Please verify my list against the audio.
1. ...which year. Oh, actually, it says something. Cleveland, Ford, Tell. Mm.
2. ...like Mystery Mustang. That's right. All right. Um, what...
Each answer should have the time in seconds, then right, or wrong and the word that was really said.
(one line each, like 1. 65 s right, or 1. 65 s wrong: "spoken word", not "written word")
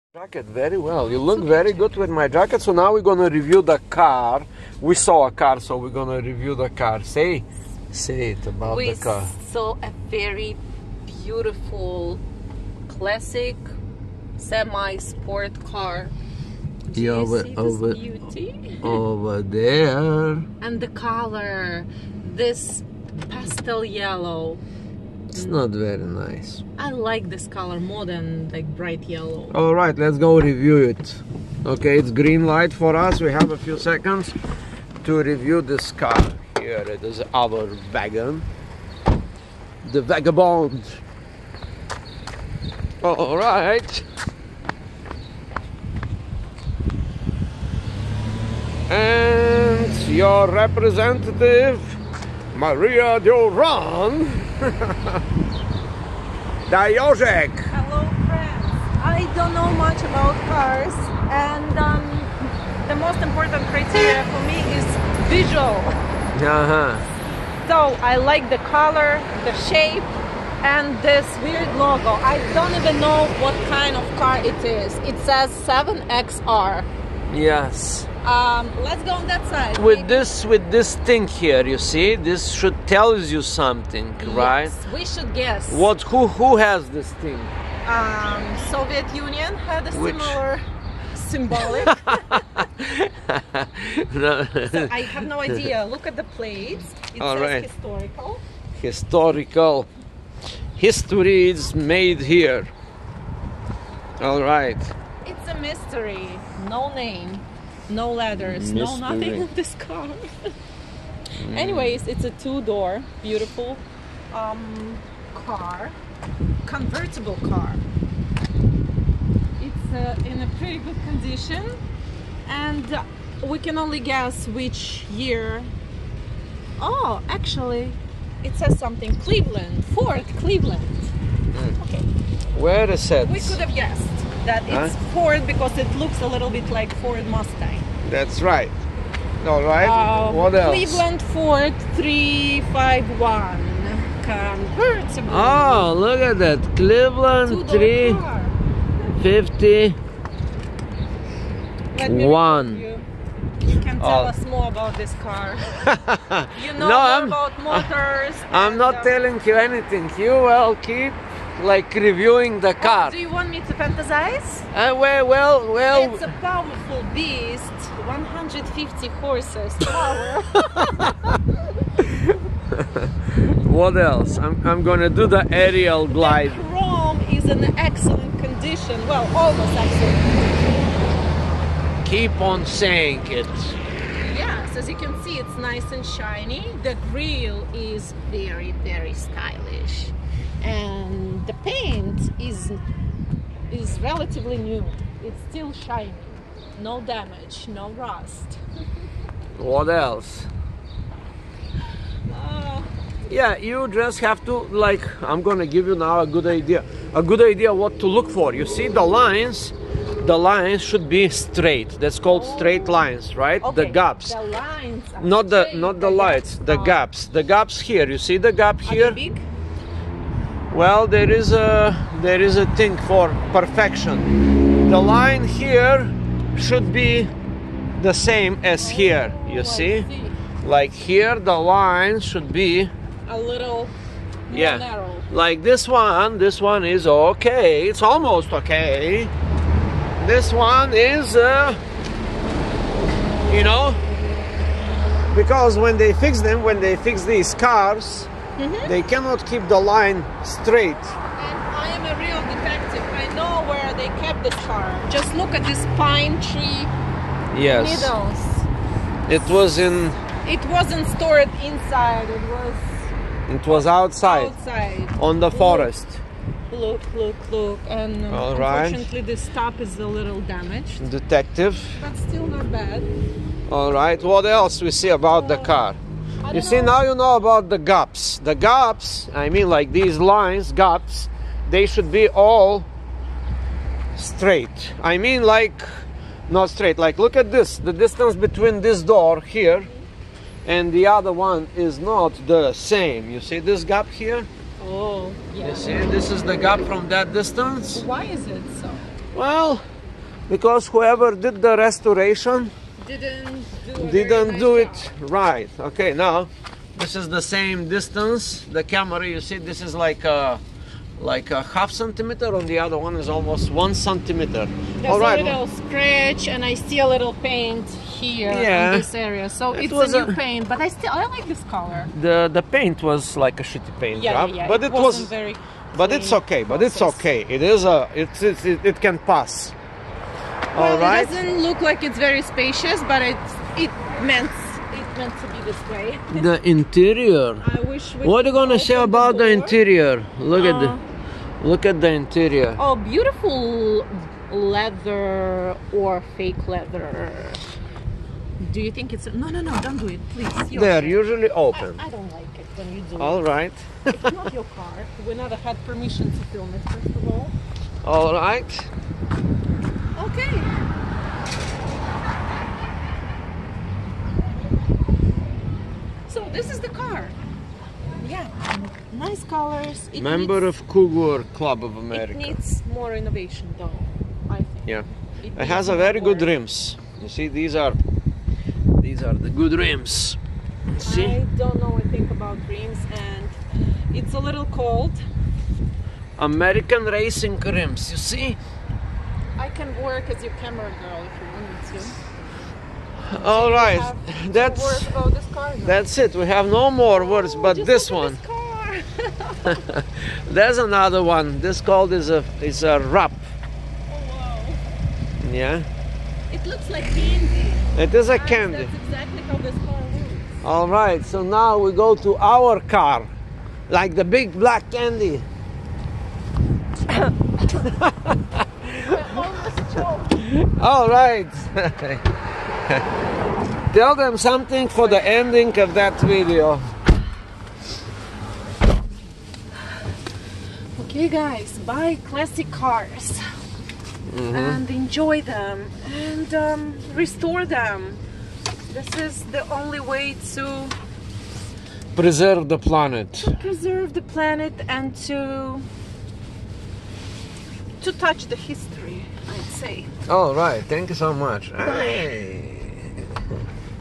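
1. 124 s wrong: "Cleveland", not "Tell"
2. 136 s wrong: "Ford", not "Mystery".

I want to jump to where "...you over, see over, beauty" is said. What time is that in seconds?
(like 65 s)
17 s.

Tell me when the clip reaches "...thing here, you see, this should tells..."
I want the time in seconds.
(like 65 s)
80 s.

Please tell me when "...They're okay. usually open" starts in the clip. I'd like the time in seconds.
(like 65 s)
350 s.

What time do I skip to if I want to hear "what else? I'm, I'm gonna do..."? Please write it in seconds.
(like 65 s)
173 s.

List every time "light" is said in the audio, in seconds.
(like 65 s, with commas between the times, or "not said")
32 s, 216 s.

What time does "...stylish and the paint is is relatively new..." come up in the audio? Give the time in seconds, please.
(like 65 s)
189 s.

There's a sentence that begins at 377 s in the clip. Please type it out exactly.
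You see, these are these are the good rims.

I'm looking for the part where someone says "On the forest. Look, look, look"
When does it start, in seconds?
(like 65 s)
265 s.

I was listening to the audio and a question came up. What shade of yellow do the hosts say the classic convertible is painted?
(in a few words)
Pastel yellow.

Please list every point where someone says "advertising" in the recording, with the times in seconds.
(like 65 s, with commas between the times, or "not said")
not said.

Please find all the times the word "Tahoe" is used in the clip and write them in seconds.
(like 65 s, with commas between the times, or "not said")
not said.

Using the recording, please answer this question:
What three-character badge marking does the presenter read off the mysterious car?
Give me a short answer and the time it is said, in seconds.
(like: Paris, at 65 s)
7XR, at 75 s.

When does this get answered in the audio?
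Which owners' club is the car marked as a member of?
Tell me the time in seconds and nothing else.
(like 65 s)
370 s.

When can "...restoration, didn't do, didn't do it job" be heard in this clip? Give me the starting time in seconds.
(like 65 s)
301 s.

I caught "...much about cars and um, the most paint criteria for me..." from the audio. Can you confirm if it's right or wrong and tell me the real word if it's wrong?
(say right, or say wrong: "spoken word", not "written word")
wrong: "important", not "paint".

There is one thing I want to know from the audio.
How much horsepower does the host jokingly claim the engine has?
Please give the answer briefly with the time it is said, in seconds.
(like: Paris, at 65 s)
150, at 168 s.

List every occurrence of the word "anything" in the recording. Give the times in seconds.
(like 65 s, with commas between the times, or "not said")
159 s, 381 s.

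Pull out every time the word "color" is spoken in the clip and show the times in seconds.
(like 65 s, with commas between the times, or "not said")
20 s, 27 s, 68 s, 321 s, 369 s.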